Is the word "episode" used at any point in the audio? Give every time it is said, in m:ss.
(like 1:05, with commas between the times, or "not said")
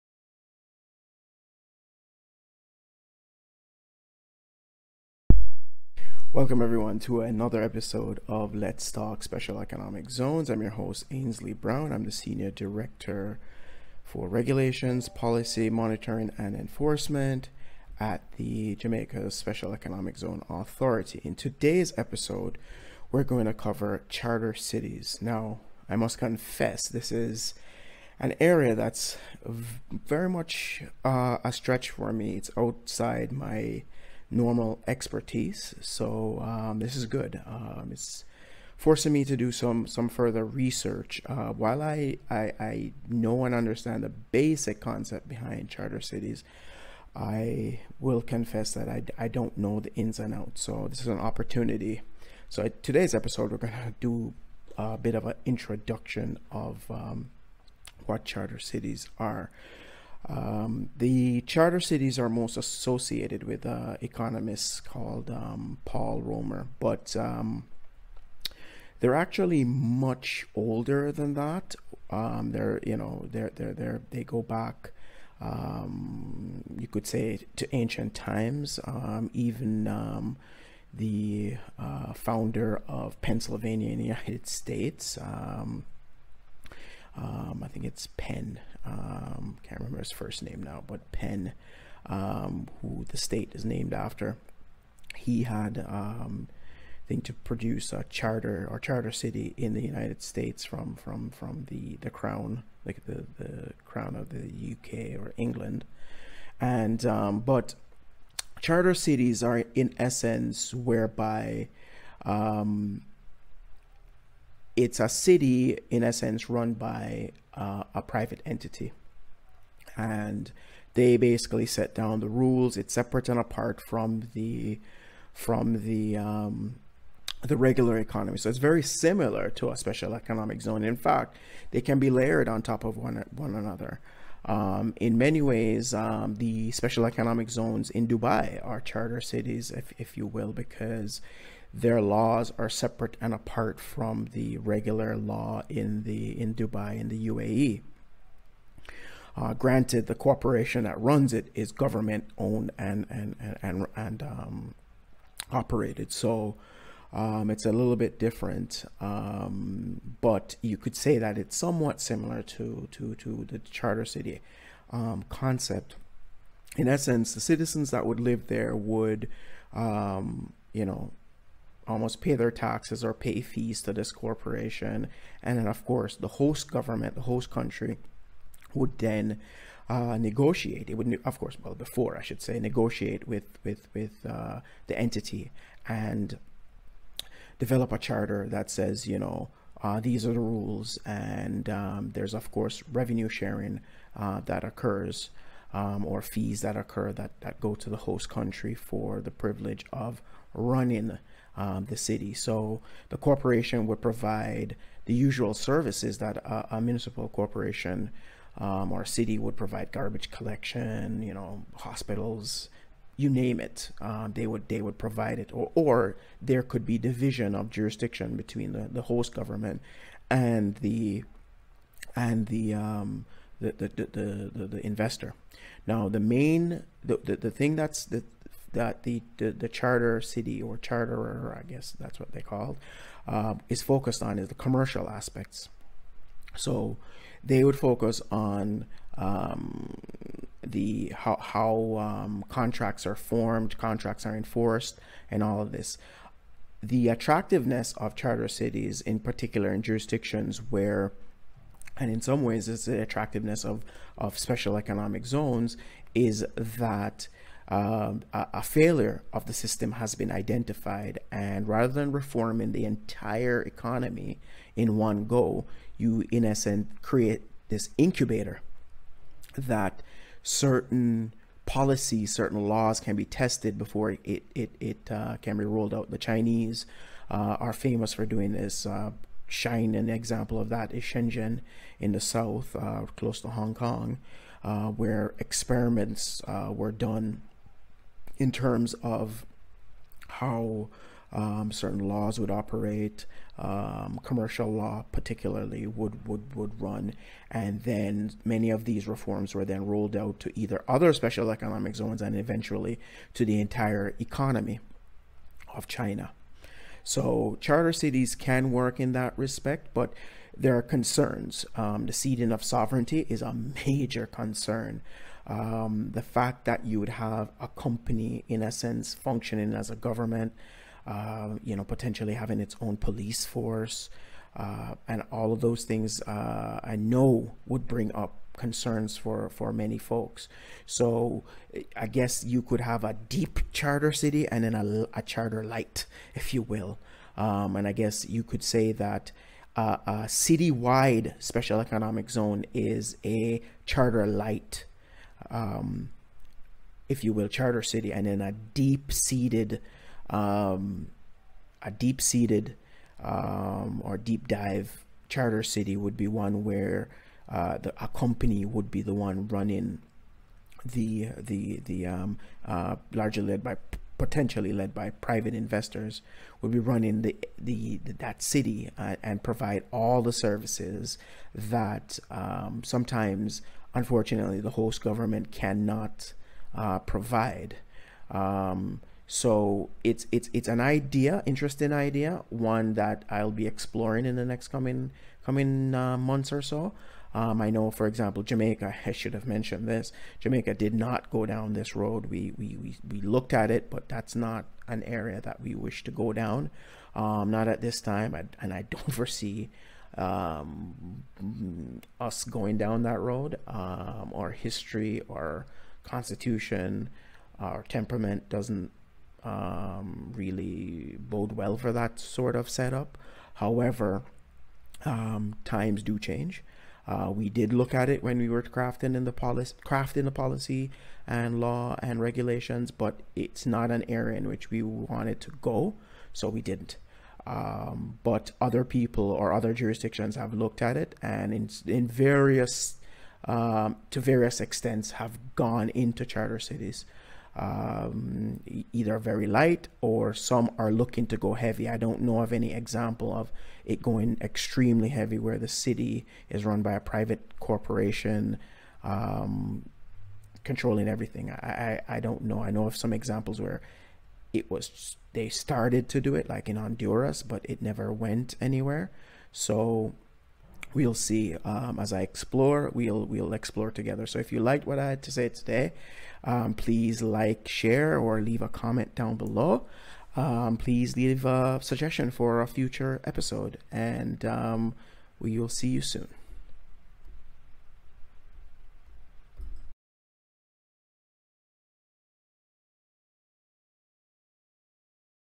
0:07, 0:21, 0:53, 7:53.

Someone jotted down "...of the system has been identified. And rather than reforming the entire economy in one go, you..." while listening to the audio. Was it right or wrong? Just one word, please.
right.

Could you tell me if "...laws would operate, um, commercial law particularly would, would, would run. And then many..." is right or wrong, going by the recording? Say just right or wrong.
right.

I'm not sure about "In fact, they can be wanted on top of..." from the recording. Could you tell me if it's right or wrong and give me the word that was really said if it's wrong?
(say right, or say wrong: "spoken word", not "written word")
wrong: "layered", not "wanted".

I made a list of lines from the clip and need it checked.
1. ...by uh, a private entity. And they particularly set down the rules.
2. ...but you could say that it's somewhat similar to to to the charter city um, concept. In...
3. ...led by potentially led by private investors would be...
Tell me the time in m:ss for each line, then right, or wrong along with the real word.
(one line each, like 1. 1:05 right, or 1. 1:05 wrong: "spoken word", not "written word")
1. 1:56 wrong: "basically", not "particularly"
2. 2:40 right
3. 6:03 right.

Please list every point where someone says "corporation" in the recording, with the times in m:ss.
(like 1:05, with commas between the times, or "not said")
2:30, 2:54, 3:23, 3:27, 7:27.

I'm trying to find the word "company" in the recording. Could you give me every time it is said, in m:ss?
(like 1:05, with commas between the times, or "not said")
5:17, 5:58.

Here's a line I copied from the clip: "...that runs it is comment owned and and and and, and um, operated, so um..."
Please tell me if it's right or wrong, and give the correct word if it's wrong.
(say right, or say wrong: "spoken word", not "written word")
wrong: "government", not "comment".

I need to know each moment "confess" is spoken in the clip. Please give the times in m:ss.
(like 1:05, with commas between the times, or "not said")
0:26, 0:48.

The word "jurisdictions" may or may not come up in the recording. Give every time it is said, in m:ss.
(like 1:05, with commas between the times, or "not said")
3:37, 4:09, 7:09.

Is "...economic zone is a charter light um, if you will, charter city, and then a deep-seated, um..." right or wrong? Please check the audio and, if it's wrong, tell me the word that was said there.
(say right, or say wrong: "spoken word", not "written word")
right.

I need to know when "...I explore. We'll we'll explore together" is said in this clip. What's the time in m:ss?
7:42.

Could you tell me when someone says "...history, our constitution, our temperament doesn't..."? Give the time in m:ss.
6:44.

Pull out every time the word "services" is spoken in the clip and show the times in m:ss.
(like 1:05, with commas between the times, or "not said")
3:25, 6:10.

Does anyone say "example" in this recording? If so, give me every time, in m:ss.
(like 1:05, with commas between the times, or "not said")
4:40, 6:28, 7:22, 7:33.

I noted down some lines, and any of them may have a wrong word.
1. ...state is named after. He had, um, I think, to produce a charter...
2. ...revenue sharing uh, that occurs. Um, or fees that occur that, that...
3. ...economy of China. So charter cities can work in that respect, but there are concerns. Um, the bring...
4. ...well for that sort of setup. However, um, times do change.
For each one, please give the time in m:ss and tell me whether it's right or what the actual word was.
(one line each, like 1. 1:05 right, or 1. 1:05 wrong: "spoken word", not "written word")
1. 1:33 right
2. 3:12 right
3. 5:04 wrong: "ceding", not "bring"
4. 6:51 right.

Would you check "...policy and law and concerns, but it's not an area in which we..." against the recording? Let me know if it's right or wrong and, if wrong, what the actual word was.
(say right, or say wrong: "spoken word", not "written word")
wrong: "regulations", not "concerns".